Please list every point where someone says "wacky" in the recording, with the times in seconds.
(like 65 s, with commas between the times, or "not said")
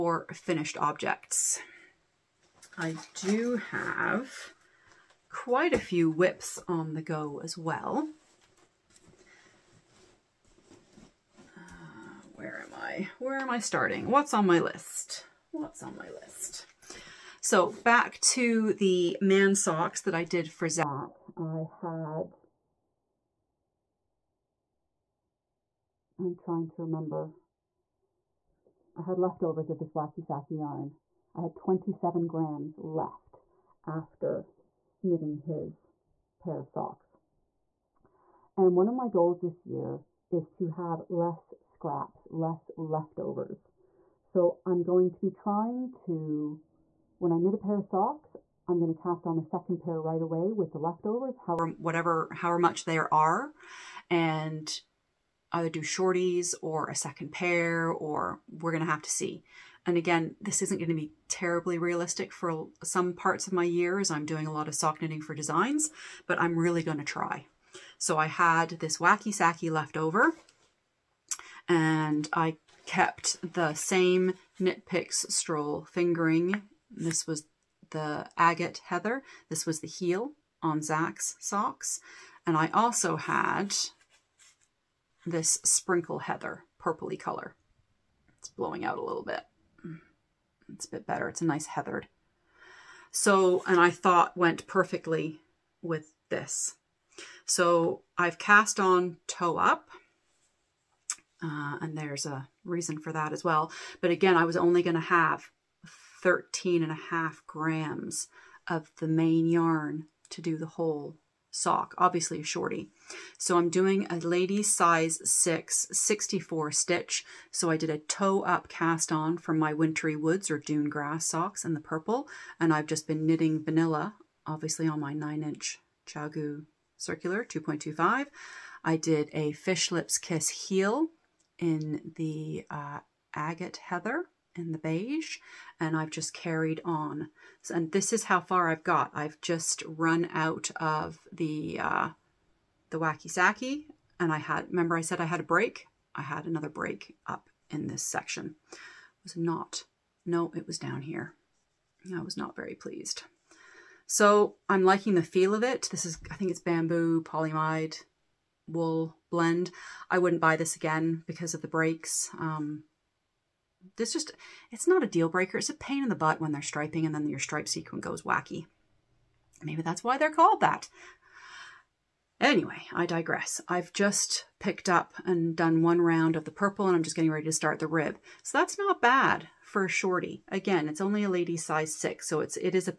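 29 s, 68 s, 142 s, 168 s.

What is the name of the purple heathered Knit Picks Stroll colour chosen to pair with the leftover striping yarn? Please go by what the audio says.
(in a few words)
Sprinkle Heather.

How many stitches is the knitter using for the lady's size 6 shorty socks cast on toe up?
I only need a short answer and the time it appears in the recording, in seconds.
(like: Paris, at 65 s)
64, at 115 s.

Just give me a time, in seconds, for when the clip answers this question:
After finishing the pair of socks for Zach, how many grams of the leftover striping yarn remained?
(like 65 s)
31 s.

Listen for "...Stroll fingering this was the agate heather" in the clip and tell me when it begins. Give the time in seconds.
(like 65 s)
75 s.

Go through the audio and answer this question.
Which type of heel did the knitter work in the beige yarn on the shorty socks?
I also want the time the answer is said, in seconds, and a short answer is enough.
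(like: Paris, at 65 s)
Fish Lips Kiss heel, at 129 s.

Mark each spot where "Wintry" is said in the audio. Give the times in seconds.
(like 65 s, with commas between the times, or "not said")
119 s.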